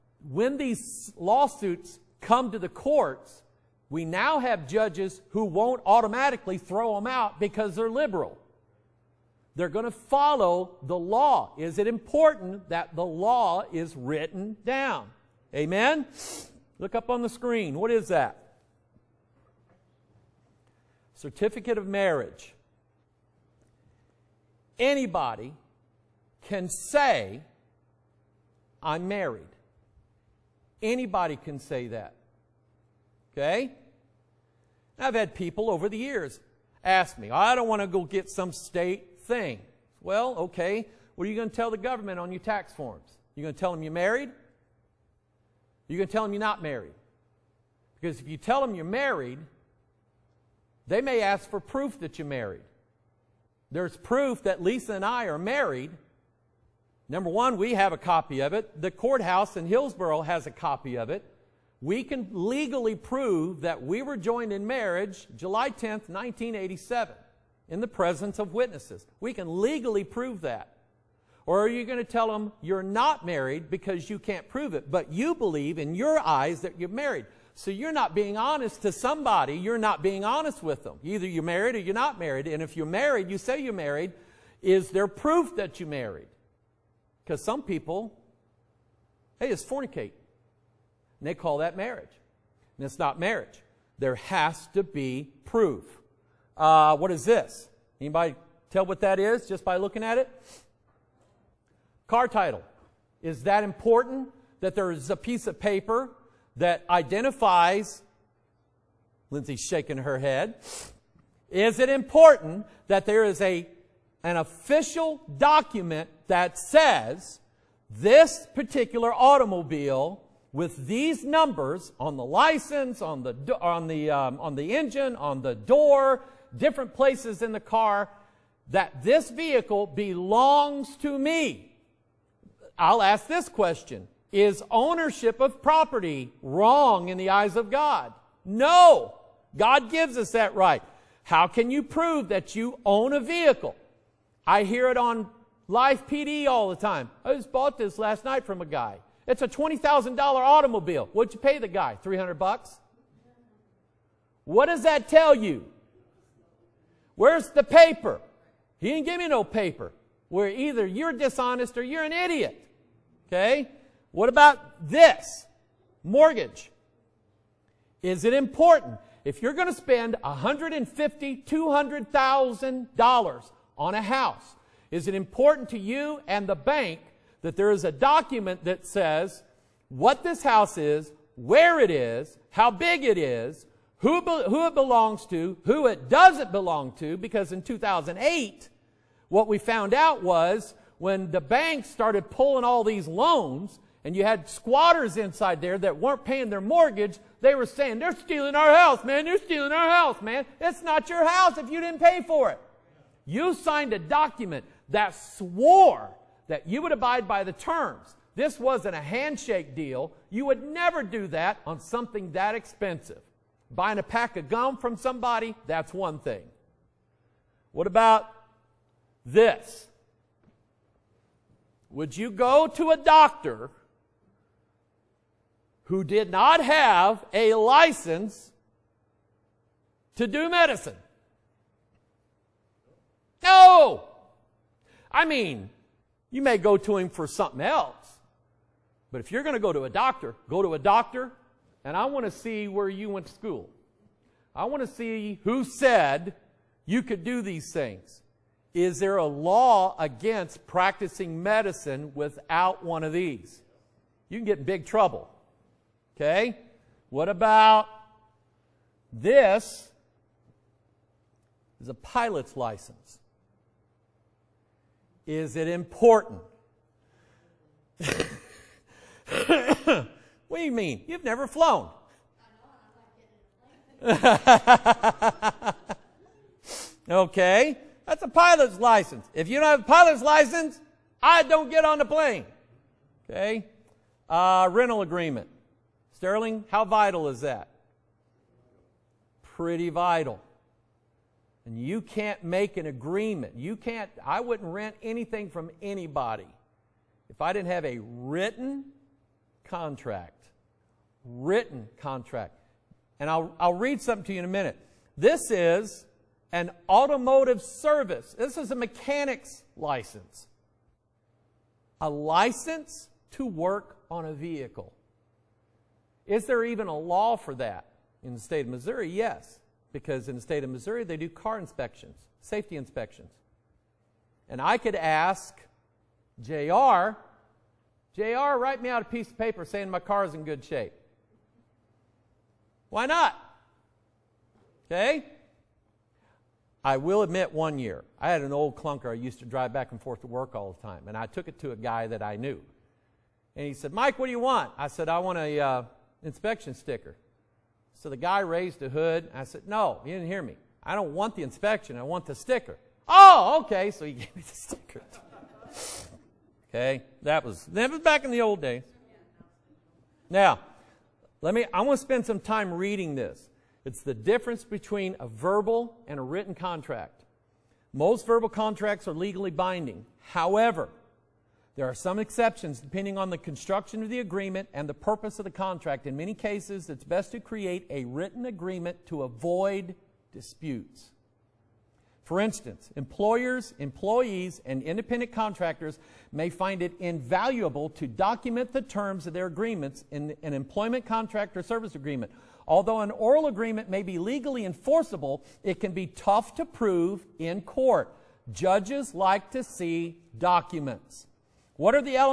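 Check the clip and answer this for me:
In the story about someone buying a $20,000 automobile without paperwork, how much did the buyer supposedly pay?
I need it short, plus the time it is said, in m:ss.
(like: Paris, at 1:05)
300 bucks, at 2:32.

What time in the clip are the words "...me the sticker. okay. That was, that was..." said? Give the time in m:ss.
5:54.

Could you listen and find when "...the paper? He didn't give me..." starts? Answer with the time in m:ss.
2:37.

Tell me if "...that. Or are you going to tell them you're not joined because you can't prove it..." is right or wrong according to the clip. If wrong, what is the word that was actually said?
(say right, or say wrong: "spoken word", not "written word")
wrong: "married", not "joined".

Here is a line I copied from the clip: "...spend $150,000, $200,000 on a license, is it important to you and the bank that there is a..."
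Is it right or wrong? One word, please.
wrong.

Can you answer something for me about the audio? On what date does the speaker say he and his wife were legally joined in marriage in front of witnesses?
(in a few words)
July 10th, 1987.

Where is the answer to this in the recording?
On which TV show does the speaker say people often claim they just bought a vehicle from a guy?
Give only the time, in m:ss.
2:25.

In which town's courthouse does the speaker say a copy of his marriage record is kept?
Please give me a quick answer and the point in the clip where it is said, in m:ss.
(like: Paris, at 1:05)
Hillsboro, at 0:59.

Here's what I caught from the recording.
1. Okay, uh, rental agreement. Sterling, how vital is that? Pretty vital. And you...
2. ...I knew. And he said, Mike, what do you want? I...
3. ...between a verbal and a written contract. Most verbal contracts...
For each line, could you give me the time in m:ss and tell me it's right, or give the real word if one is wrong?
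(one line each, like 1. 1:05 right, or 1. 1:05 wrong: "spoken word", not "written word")
1. 4:43 right
2. 5:42 right
3. 6:04 right.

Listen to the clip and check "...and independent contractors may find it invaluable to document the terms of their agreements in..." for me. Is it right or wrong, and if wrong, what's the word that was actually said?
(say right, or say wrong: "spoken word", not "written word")
right.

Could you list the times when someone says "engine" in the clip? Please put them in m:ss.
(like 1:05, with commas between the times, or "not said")
2:04.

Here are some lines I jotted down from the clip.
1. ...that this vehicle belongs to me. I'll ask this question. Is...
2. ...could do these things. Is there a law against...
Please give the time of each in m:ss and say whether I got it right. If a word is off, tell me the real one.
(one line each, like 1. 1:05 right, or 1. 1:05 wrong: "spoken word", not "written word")
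1. 2:08 right
2. 4:07 right.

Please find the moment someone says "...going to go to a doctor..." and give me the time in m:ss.
3:59.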